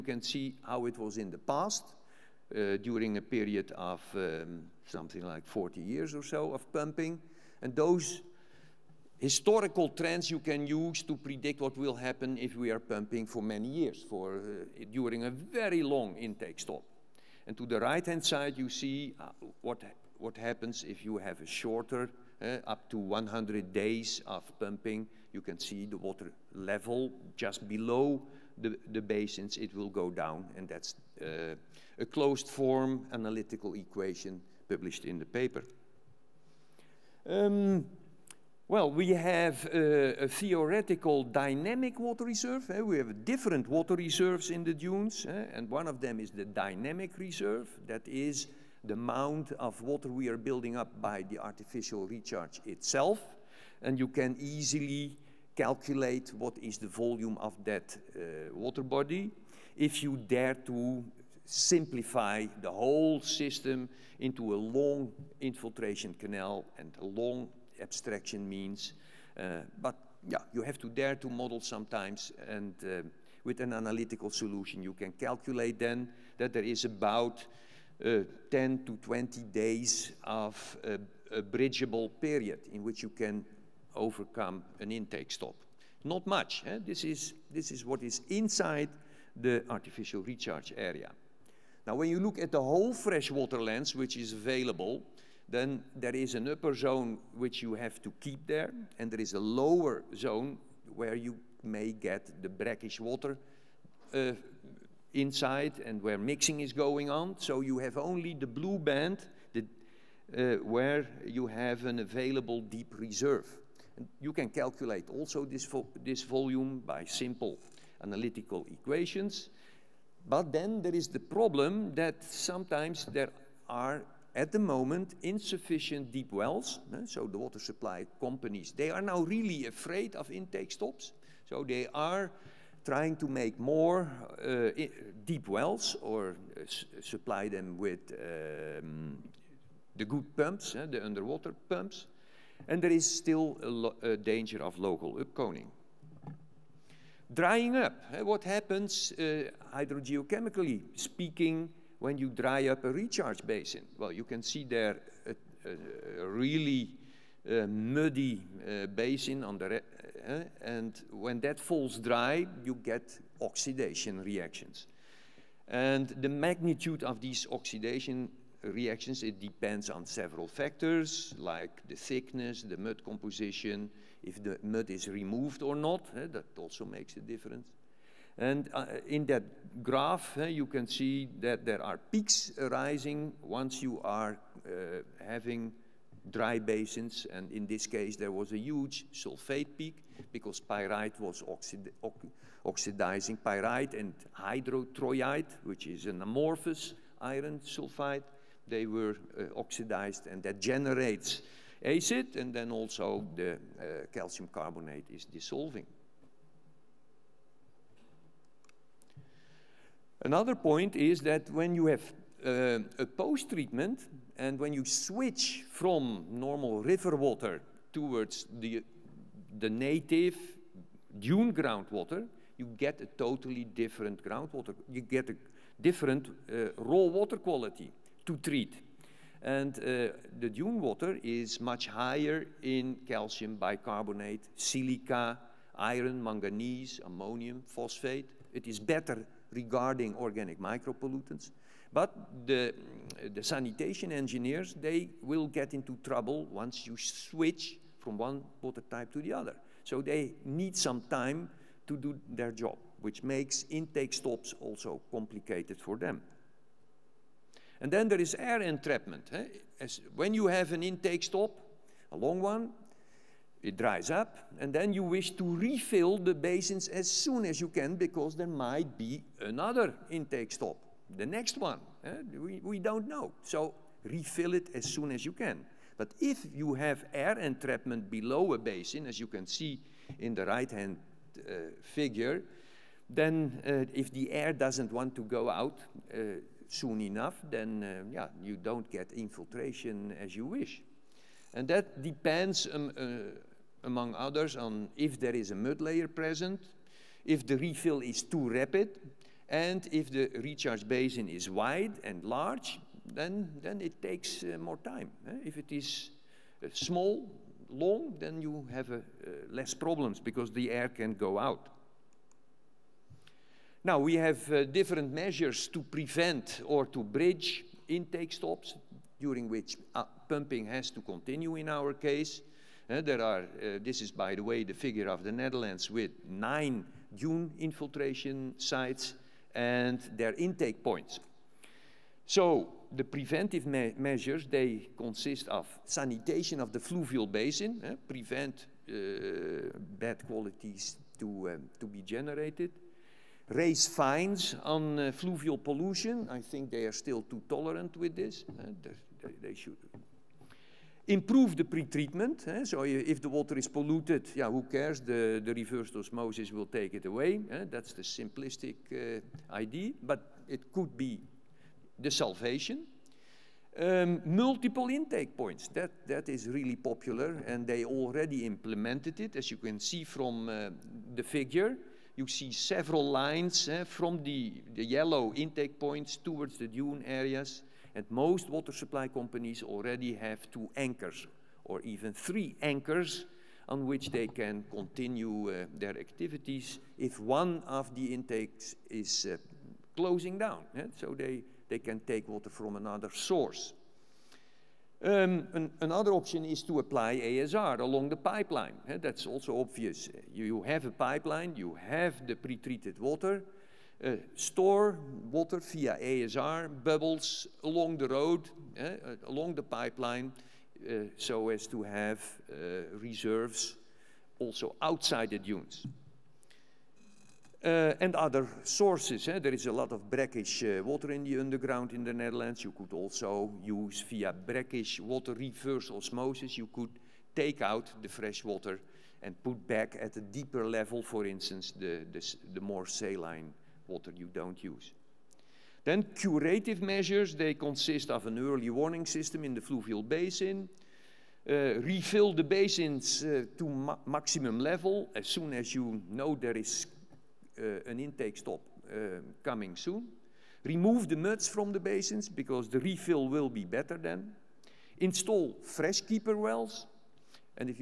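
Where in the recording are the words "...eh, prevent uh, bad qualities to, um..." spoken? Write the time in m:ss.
5:37.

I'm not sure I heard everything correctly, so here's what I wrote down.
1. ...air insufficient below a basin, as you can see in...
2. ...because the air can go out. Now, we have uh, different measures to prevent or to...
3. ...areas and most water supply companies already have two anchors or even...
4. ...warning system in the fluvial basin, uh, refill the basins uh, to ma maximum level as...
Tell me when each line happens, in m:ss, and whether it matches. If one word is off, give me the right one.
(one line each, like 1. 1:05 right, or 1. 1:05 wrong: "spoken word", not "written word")
1. 4:37 wrong: "entrapment", not "insufficient"
2. 5:10 right
3. 6:17 right
4. 7:18 right.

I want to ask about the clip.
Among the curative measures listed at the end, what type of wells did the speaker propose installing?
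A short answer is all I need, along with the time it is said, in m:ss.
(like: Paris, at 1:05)
fresh keeper wells, at 7:35.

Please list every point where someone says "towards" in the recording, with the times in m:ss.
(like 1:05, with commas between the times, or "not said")
3:37, 6:16.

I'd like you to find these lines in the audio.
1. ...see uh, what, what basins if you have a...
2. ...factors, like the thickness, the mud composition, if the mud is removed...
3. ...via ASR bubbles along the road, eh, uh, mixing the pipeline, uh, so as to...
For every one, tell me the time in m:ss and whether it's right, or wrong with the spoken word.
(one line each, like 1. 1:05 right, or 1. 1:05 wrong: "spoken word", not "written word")
1. 0:18 wrong: "happens", not "basins"
2. 2:50 right
3. 6:45 wrong: "along", not "mixing".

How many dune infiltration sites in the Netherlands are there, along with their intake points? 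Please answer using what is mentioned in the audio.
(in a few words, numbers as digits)
9.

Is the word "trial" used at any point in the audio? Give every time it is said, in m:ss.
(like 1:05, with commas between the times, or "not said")
not said.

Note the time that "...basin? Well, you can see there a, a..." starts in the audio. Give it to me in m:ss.
2:33.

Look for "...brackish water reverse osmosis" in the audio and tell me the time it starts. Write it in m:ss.
7:04.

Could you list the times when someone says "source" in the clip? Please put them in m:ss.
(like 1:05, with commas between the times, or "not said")
6:33, 6:58.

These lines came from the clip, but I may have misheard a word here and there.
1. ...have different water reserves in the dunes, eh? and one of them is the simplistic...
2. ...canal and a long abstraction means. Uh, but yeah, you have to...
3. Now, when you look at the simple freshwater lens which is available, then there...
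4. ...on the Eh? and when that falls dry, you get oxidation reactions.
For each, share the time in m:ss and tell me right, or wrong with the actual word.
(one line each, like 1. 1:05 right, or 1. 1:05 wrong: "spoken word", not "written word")
1. 0:42 wrong: "dynamic", not "simplistic"
2. 1:06 right
3. 1:31 wrong: "whole", not "simple"
4. 2:39 right.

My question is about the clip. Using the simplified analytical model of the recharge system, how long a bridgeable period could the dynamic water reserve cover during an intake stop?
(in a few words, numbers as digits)
10 to 20 days.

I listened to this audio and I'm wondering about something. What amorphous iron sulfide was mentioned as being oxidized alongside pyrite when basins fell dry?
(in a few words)
hydrotroilite.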